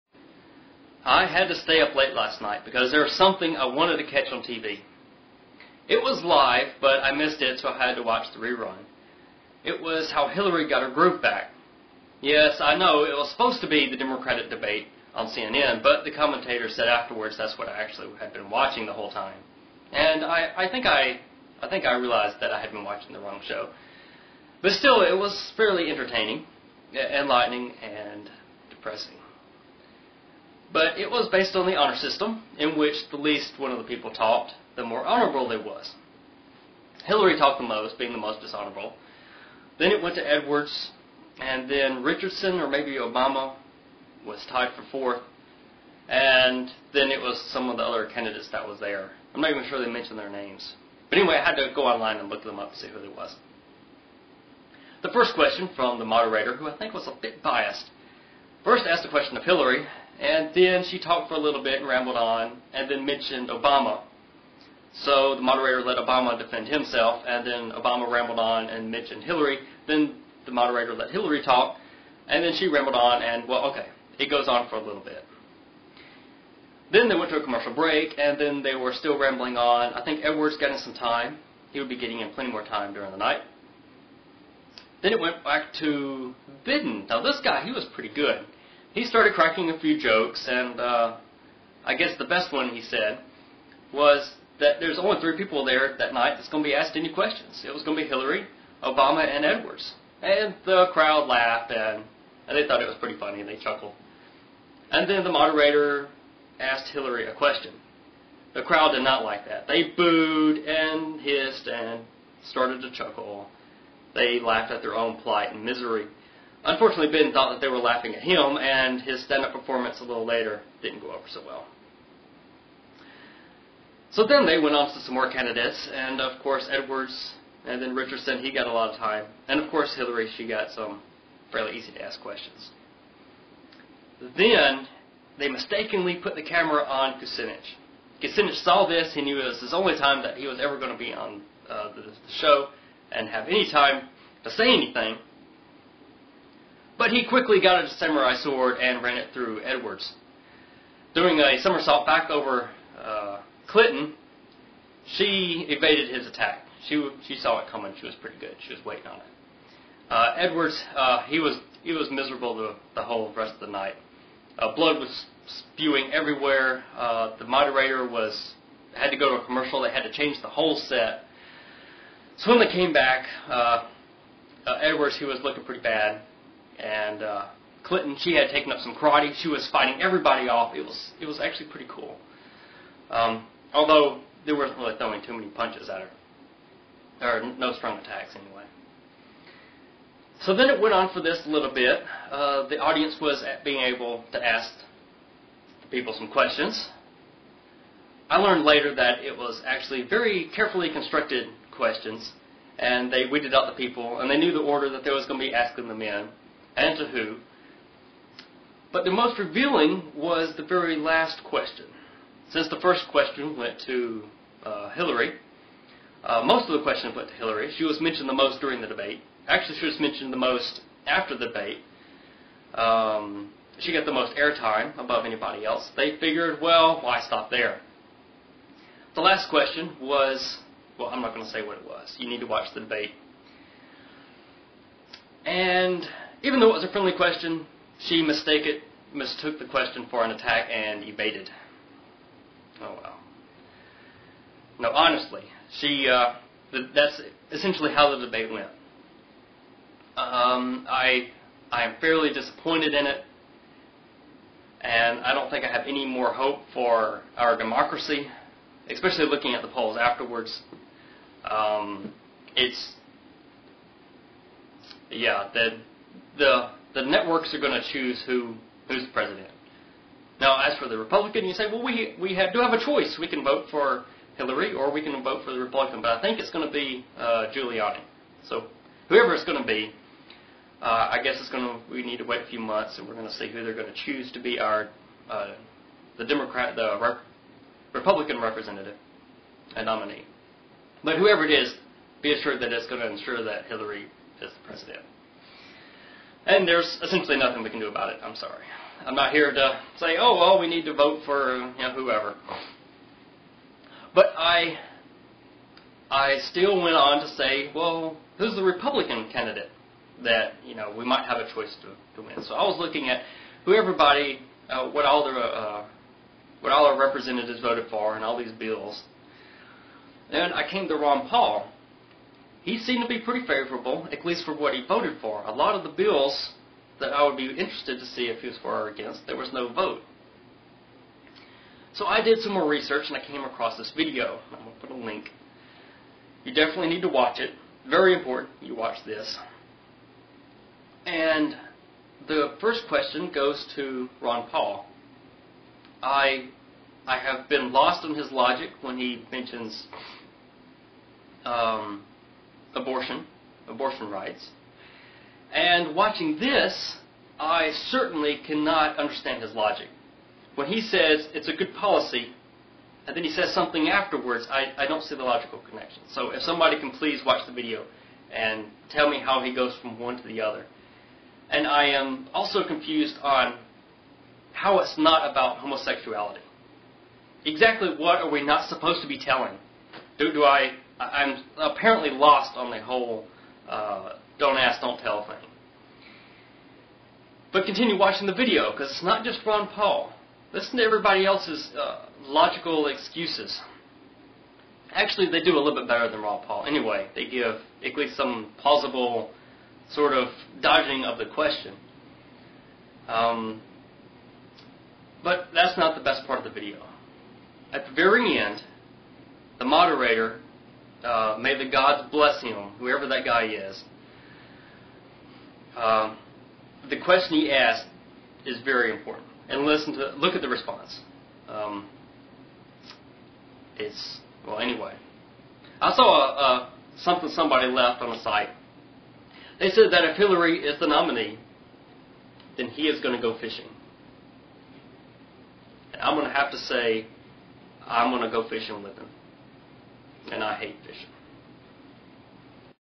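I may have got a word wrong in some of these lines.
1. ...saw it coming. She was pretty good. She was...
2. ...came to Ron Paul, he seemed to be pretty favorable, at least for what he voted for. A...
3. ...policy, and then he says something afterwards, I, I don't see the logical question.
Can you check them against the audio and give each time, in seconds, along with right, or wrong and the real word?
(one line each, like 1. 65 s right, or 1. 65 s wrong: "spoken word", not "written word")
1. 157 s right
2. 320 s right
3. 361 s wrong: "connection", not "question".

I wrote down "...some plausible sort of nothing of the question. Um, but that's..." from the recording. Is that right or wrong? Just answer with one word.
wrong.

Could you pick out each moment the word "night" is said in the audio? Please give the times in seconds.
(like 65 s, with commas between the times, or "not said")
2 s, 83 s, 96 s, 163 s.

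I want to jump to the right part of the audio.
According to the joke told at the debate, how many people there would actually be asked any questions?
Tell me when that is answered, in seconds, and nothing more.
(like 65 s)
95 s.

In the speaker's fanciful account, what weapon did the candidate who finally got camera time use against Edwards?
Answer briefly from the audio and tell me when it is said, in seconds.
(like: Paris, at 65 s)
samurai sword, at 147 s.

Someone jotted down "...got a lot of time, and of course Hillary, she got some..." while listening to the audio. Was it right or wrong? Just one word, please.
right.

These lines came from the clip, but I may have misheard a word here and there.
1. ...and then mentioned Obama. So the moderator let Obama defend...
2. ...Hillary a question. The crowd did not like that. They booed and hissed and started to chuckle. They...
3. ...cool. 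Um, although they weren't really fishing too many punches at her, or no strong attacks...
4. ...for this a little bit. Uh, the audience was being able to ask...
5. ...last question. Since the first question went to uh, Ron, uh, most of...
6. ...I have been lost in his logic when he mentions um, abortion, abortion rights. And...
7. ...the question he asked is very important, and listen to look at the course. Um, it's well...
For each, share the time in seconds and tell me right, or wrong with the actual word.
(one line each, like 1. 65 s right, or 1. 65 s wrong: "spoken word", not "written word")
1. 62 s right
2. 106 s right
3. 181 s wrong: "throwing", not "fishing"
4. 191 s right
5. 210 s wrong: "Hillary", not "Ron"
6. 347 s right
7. 416 s wrong: "response", not "course".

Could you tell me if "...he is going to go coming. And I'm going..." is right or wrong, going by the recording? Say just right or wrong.
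wrong.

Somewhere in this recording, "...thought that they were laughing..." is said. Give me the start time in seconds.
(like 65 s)
117 s.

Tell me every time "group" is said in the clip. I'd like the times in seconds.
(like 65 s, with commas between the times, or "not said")
10 s.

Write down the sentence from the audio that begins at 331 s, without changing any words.
So I did some more research and I came across this video.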